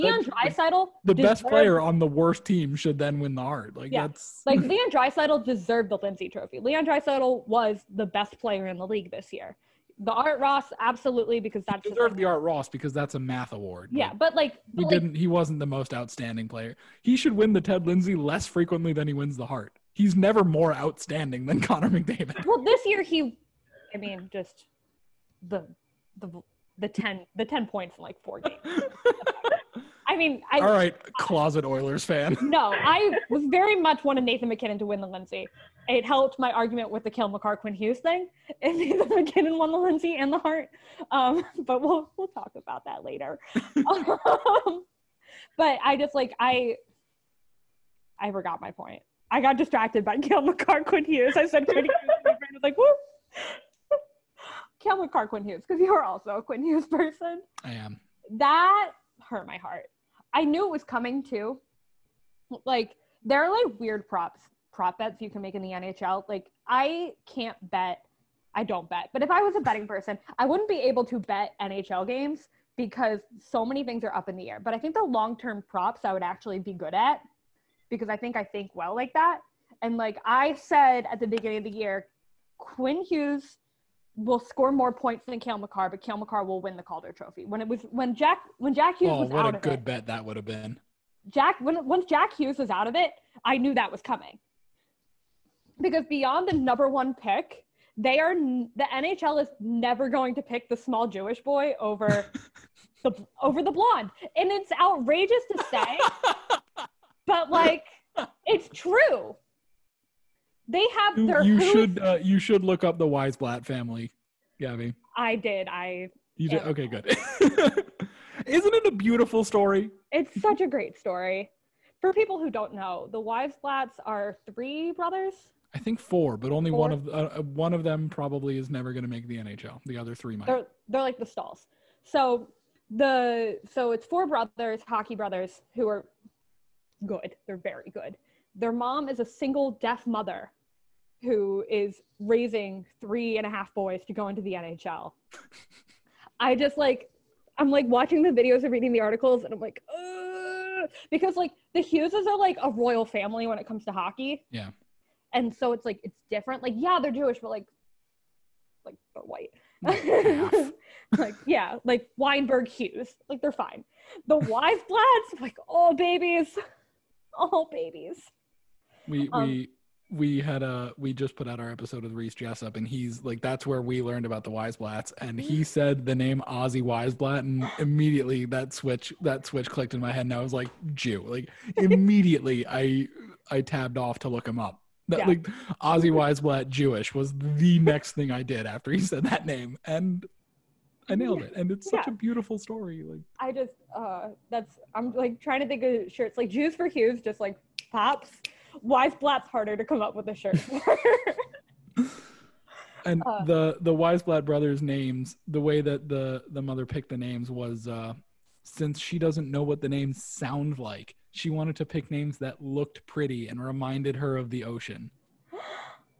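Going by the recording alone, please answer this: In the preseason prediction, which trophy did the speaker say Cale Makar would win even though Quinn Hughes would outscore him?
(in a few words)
Calder Trophy.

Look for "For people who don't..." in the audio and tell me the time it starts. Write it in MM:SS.
02:02.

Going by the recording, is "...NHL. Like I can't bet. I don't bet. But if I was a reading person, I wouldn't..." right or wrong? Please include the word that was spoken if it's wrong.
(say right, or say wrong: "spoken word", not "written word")
wrong: "betting", not "reading".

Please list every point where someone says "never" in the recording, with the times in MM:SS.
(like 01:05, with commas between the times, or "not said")
00:20, 01:39, 02:08.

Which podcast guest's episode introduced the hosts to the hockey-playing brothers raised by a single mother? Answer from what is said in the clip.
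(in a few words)
Reese Jessup.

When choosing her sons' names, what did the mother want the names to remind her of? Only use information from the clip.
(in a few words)
the ocean.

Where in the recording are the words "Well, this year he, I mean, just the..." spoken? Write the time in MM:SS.
00:22.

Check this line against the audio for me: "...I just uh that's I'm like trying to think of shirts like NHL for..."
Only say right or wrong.
wrong.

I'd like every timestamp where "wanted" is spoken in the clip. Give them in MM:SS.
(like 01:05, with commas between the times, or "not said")
00:34, 03:31.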